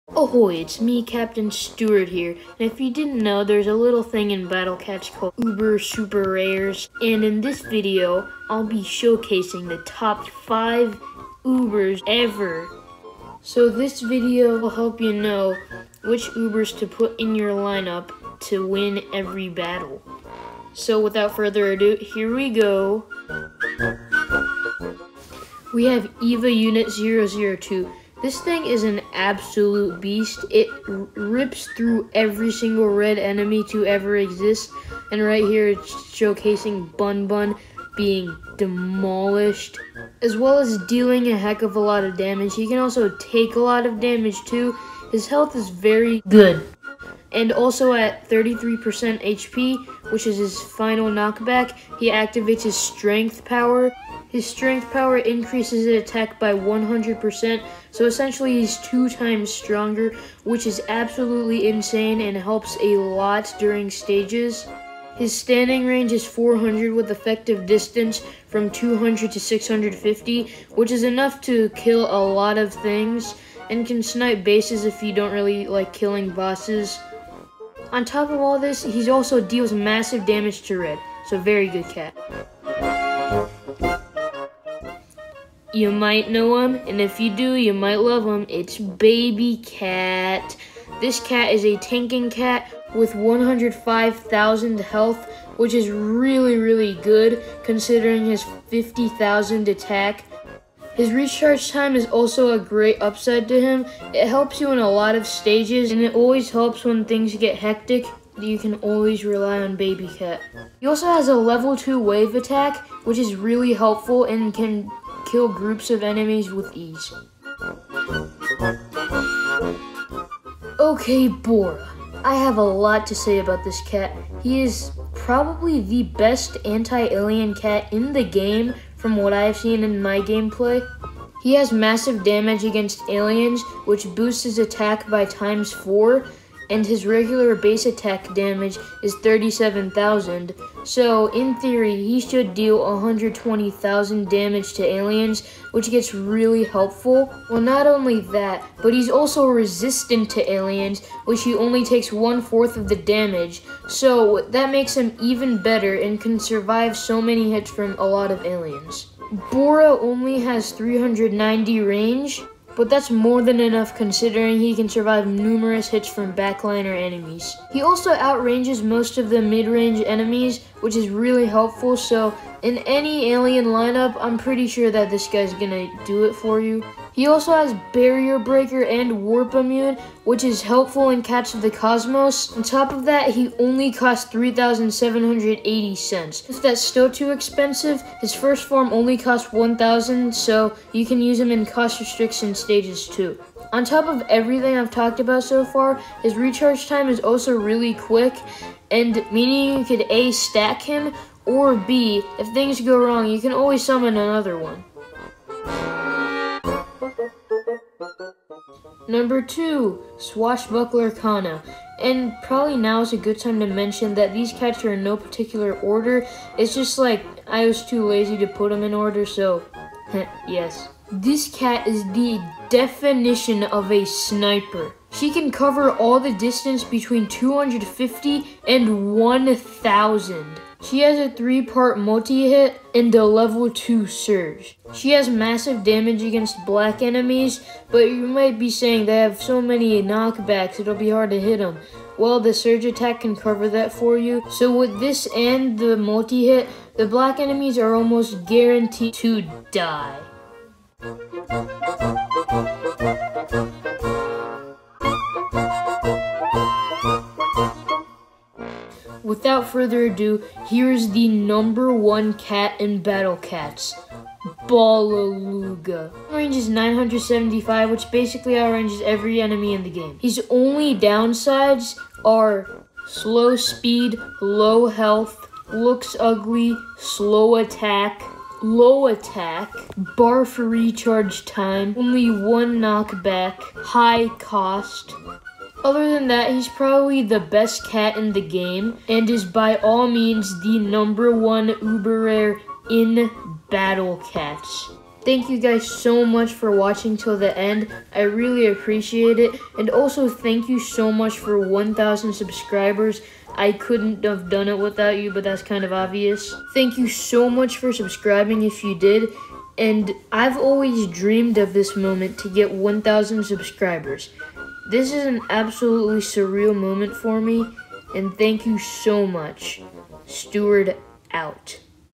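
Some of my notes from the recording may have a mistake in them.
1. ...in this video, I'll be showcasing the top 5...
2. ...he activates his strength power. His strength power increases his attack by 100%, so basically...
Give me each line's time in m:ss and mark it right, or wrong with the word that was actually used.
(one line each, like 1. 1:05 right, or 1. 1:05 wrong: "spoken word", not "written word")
1. 0:07 right
2. 0:51 wrong: "essentially", not "basically".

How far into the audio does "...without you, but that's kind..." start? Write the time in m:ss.
5:04.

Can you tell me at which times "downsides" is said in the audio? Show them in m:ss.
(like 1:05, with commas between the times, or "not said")
4:30.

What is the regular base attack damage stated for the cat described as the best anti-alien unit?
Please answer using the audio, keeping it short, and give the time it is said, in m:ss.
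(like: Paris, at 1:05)
37,000, at 2:19.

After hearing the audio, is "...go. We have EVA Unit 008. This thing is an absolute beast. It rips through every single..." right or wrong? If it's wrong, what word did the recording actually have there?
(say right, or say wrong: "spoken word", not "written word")
wrong: "002", not "008".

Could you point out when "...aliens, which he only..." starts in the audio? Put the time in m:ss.
2:30.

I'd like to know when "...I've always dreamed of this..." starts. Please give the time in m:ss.
5:10.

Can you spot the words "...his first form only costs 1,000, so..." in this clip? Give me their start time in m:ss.
3:08.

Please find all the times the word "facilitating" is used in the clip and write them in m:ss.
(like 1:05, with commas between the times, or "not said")
not said.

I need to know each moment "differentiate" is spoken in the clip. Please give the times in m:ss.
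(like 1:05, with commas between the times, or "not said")
not said.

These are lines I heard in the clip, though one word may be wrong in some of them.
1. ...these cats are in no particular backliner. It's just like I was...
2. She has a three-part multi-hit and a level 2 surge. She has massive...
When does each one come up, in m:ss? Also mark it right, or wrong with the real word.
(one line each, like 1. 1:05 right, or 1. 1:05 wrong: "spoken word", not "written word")
1. 3:34 wrong: "order", not "backliner"
2. 3:50 right.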